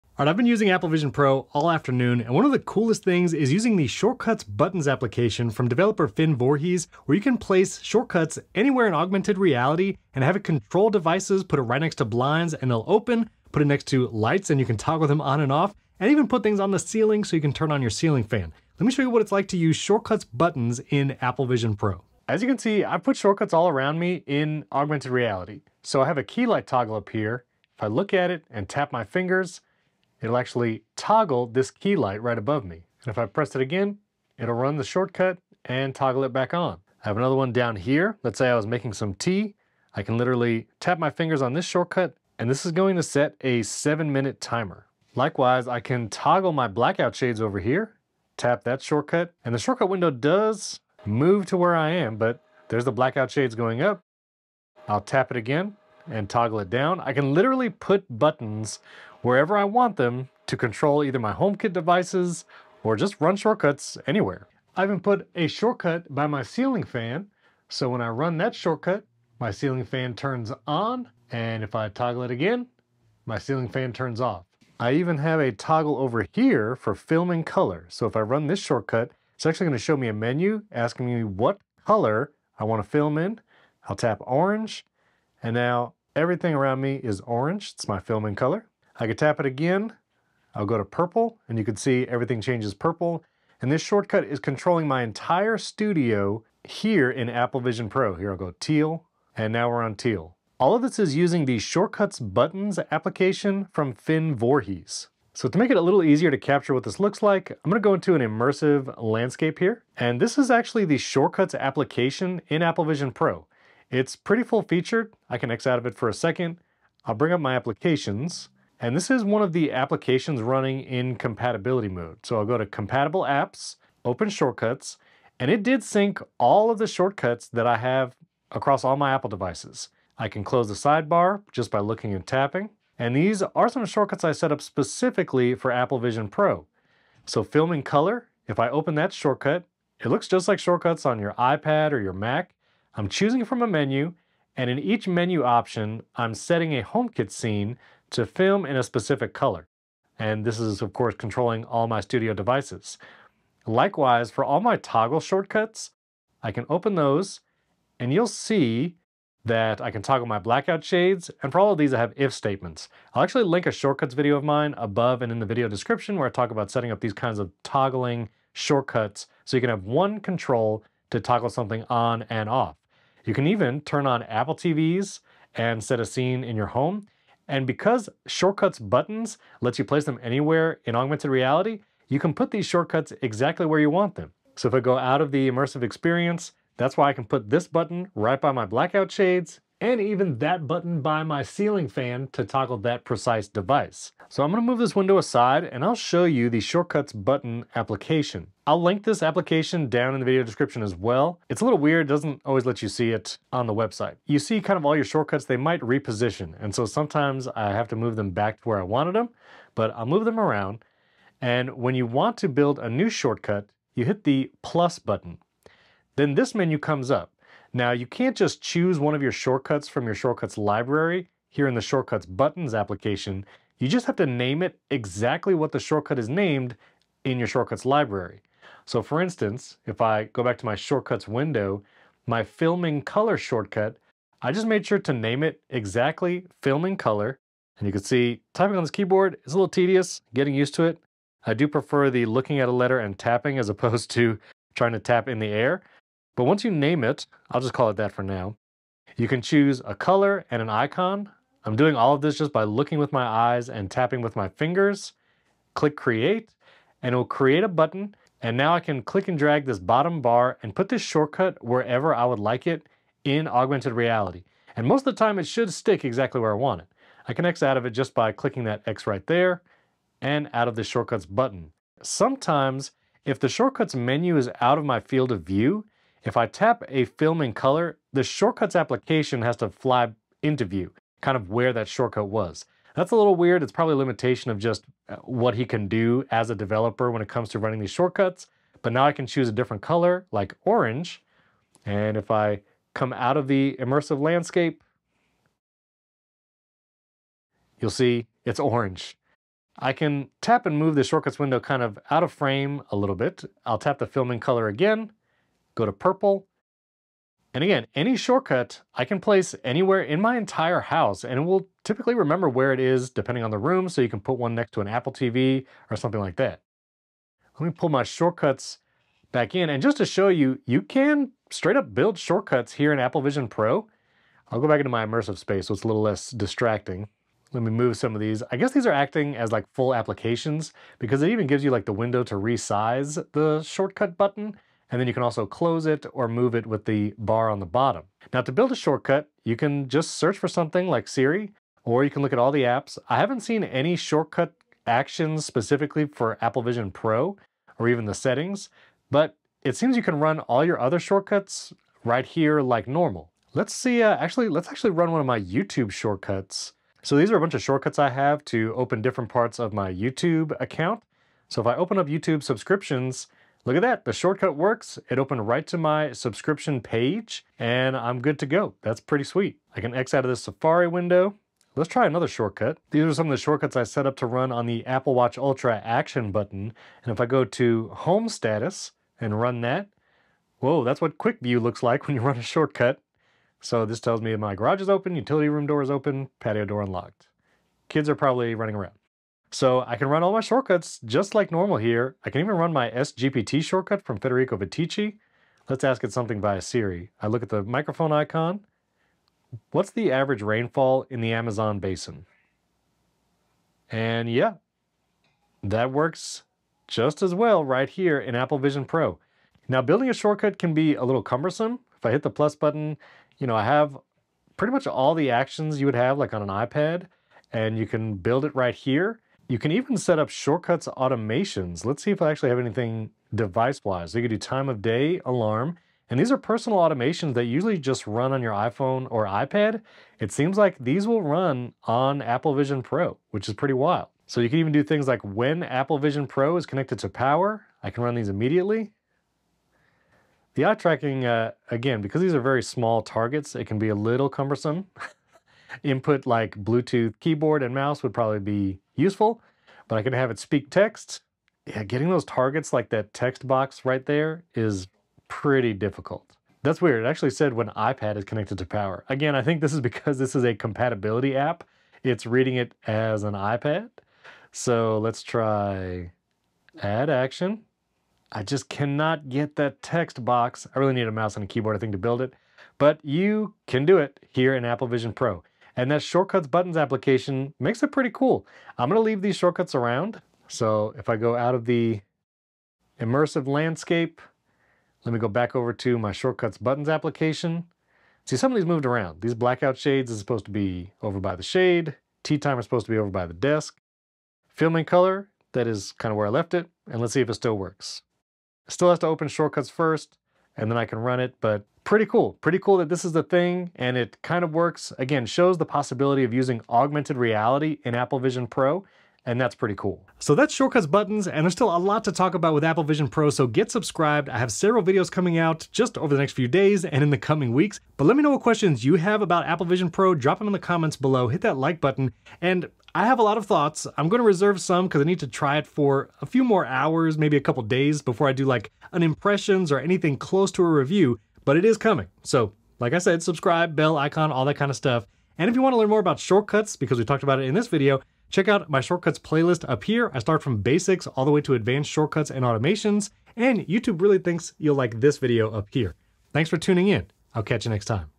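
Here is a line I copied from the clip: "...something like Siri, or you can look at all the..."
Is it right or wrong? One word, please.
right.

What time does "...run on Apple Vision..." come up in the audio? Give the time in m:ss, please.
7:11.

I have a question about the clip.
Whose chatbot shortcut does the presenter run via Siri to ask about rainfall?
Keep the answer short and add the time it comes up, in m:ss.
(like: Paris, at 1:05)
Federico Viticci, at 6:34.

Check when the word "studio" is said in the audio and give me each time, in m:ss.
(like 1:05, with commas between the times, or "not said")
1:35, 2:32.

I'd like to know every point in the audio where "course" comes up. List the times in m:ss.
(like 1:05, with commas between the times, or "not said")
2:30.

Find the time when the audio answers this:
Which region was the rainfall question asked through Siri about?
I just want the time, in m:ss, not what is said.
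6:41.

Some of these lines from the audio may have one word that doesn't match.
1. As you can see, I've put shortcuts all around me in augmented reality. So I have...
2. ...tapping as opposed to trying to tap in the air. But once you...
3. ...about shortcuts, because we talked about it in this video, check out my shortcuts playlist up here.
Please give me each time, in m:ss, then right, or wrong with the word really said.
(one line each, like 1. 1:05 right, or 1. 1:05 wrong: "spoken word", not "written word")
1. 0:22 right
2. 4:03 right
3. 8:56 right.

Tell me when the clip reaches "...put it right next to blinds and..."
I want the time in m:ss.
0:11.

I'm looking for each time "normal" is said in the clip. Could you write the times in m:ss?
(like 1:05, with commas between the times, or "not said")
5:52, 6:31.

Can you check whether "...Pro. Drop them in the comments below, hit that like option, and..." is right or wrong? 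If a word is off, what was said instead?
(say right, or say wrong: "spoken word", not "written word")
wrong: "button", not "option".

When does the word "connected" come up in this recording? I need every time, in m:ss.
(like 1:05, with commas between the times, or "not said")
7:16, 7:38.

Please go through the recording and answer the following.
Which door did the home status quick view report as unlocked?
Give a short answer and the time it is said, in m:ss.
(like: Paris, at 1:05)
Patio door, at 6:26.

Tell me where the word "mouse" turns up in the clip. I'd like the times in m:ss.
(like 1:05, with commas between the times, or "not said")
7:27, 7:51.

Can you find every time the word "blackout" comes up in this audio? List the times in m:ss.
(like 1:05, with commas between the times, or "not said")
0:46, 0:52, 2:40, 3:08, 8:09.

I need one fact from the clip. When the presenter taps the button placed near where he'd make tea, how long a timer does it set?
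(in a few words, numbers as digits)
7 minutes.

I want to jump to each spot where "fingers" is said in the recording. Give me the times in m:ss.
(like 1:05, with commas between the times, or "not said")
0:29, 0:41, 4:14.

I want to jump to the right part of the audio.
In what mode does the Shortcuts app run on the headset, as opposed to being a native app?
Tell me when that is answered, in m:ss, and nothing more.
2:01.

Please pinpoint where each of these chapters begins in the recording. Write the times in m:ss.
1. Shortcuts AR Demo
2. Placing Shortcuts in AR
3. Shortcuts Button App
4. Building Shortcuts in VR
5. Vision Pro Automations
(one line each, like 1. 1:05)
1. 0:22
2. 3:04
3. 3:18
4. 5:18
5. 6:58.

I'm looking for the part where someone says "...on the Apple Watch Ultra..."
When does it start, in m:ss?
6:14.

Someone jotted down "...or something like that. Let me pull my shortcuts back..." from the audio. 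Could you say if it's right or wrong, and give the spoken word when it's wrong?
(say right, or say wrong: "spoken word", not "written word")
right.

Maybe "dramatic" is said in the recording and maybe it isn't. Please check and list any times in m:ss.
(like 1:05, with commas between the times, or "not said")
not said.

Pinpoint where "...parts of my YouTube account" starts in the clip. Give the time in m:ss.
5:59.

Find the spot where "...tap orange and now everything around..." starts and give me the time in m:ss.
1:23.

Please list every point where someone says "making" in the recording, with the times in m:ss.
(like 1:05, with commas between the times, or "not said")
0:38.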